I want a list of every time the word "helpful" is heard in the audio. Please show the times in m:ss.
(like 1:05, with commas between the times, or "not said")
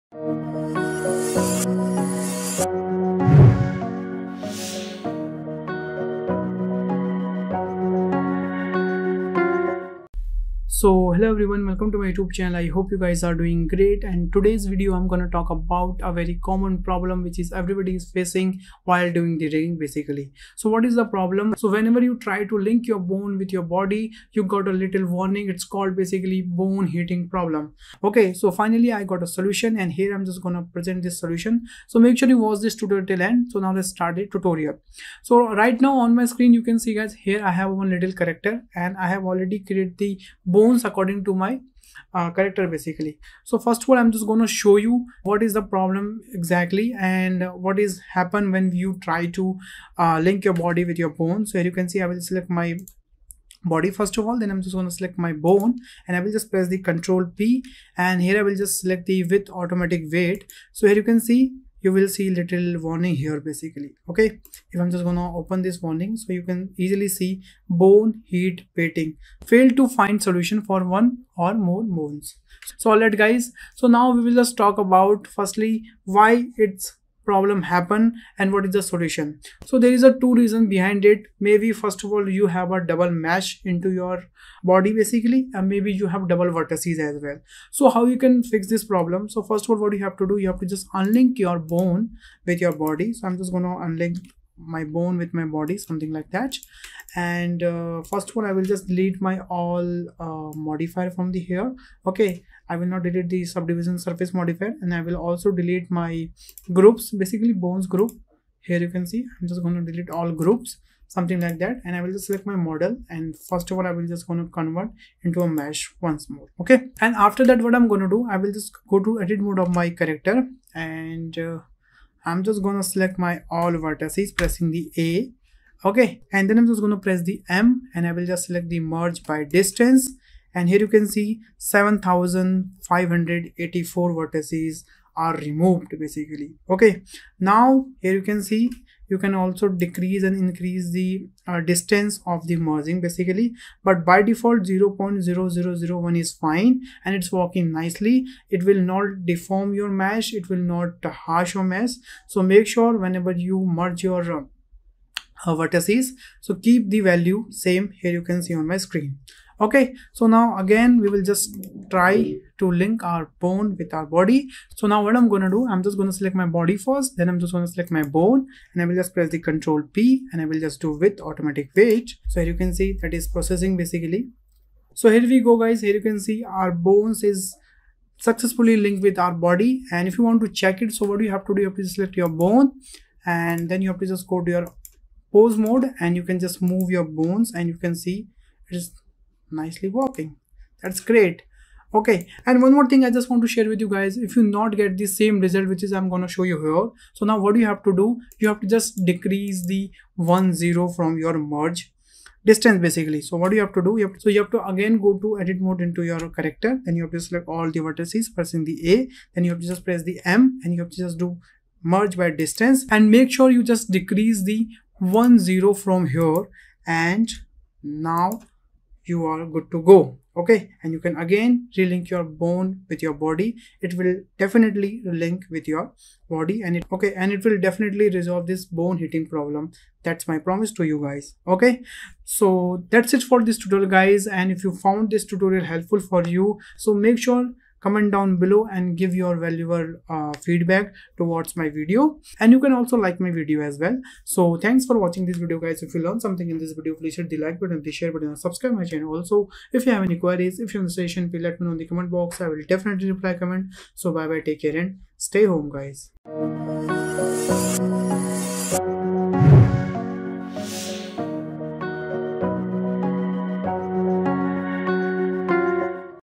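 3:55.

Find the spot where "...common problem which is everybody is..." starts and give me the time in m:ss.
0:16.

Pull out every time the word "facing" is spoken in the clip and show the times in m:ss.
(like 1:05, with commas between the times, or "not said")
0:18.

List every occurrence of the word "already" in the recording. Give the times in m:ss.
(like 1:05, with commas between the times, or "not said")
0:39.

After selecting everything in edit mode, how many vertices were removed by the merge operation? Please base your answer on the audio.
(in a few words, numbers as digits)
7584.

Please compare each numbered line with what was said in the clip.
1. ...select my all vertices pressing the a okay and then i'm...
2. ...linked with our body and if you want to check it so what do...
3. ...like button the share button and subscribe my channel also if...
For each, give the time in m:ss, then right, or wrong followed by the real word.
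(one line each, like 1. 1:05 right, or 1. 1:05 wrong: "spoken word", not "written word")
1. 2:02 right
2. 2:58 right
3. 4:07 right.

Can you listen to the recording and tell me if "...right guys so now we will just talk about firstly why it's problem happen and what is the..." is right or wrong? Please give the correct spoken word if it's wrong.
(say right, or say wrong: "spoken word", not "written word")
right.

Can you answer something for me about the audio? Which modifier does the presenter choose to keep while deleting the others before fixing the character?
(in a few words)
subdivision surface.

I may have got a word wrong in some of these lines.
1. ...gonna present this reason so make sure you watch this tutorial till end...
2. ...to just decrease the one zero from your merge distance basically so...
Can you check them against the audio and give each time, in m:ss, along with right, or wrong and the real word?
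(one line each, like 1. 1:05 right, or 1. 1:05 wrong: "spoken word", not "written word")
1. 0:30 wrong: "solution", not "reason"
2. 3:18 right.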